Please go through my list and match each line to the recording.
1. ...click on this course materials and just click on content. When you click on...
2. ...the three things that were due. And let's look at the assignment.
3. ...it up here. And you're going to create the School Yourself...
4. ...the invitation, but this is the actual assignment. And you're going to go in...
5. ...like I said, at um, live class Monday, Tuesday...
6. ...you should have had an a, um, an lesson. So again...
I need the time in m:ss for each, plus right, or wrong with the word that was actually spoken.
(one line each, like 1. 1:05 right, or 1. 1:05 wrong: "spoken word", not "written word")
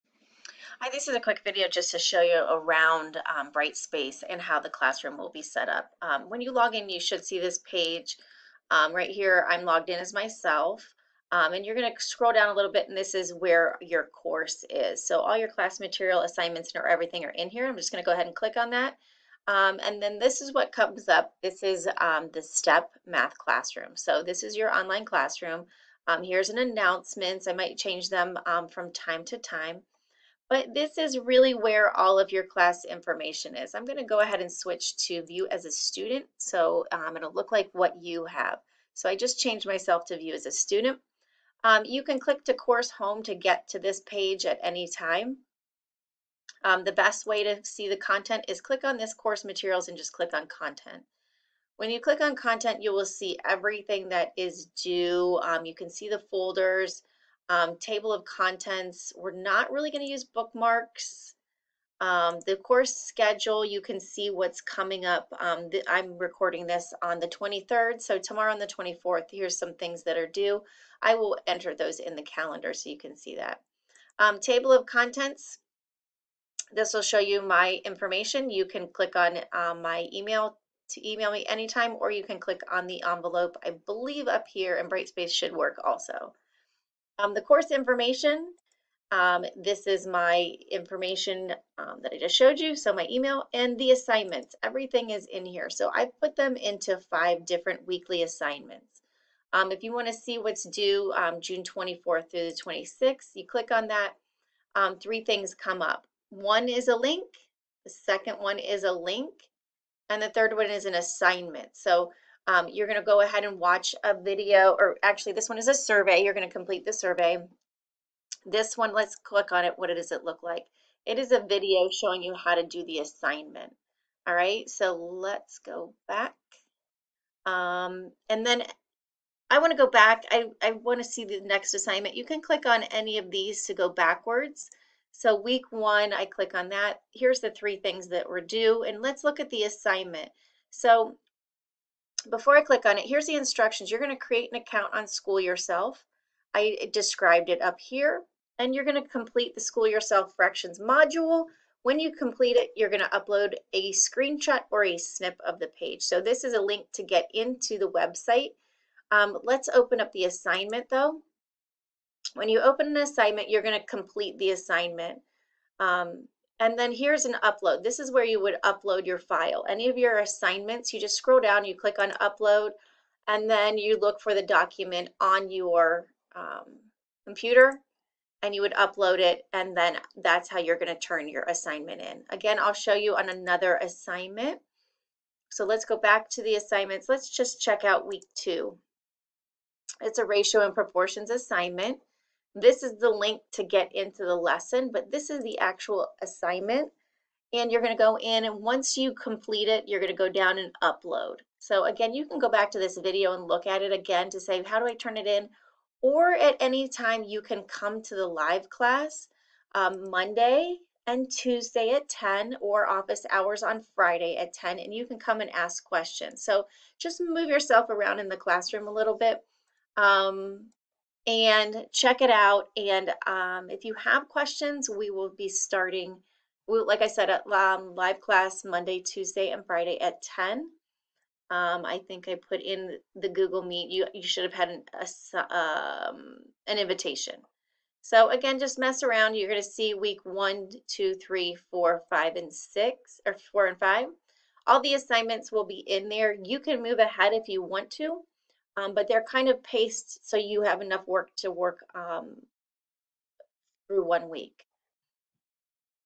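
1. 0:48 right
2. 2:17 right
3. 2:27 wrong: "complete", not "create"
4. 3:14 wrong: "lesson", not "invitation"
5. 3:46 right
6. 3:54 wrong: "invitation", not "lesson".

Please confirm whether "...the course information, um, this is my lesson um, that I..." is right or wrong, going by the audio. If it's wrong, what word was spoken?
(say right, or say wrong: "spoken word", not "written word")
wrong: "information", not "lesson".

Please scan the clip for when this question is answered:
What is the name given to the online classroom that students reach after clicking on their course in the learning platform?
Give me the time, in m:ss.
0:22.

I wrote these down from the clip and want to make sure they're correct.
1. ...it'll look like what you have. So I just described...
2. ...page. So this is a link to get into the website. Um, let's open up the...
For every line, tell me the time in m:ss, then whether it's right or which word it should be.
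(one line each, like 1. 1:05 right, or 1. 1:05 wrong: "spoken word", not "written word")
1. 0:37 wrong: "changed", not "described"
2. 2:35 right.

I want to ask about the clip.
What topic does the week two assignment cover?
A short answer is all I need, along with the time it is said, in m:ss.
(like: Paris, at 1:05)
Ratio and proportions, at 3:10.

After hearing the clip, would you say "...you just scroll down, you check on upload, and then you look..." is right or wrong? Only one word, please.
wrong.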